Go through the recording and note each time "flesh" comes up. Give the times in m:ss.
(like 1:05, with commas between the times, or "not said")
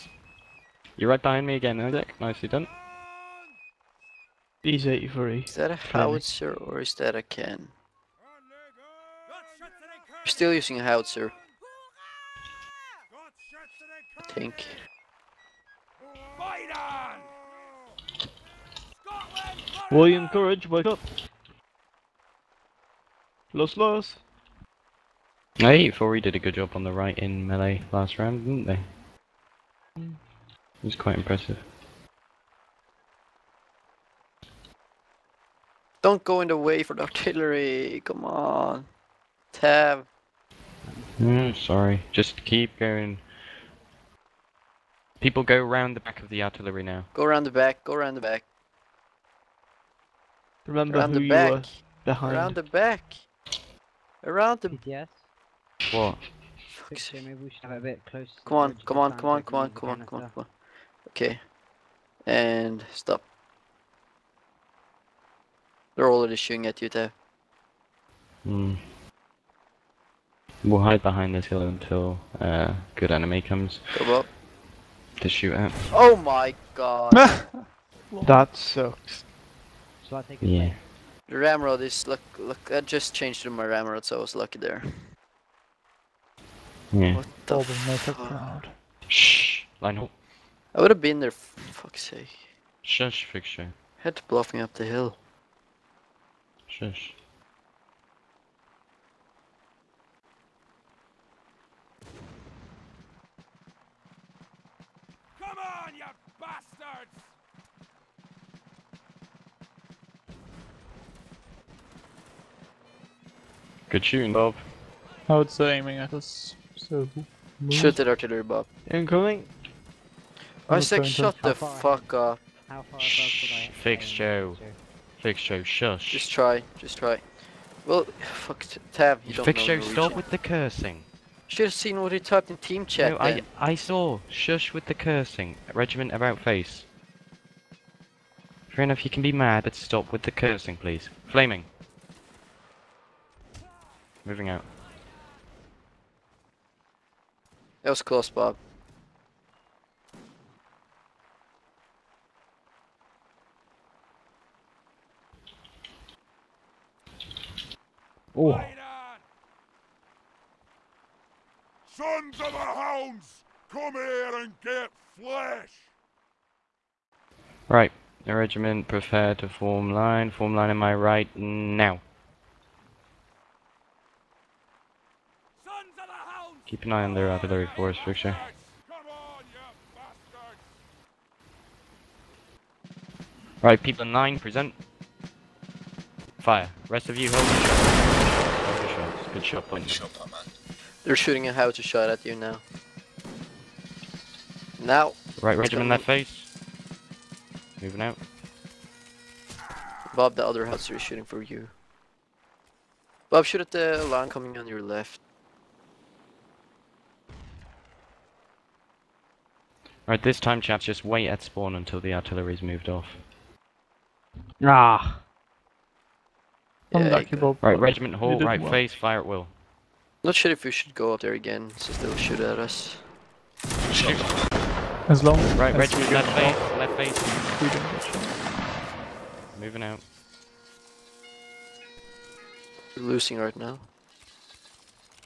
2:45.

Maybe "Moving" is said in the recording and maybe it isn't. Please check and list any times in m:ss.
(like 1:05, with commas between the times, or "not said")
2:24, 3:17, 3:49.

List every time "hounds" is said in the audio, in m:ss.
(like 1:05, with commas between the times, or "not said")
2:42.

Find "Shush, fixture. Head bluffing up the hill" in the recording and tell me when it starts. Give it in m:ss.
1:32.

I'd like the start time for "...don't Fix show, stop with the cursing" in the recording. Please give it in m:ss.
2:09.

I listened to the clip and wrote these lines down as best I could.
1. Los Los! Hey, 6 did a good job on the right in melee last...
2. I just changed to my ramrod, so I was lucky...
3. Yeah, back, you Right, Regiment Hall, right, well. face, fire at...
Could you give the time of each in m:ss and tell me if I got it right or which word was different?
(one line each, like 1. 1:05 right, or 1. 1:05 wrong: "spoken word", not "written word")
1. 0:23 wrong: "4", not "6"
2. 1:22 right
3. 3:36 right.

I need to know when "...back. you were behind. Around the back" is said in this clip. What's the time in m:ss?
0:51.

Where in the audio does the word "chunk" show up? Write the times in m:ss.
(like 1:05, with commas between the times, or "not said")
not said.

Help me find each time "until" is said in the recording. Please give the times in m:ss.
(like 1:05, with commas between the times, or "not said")
1:11, 3:31.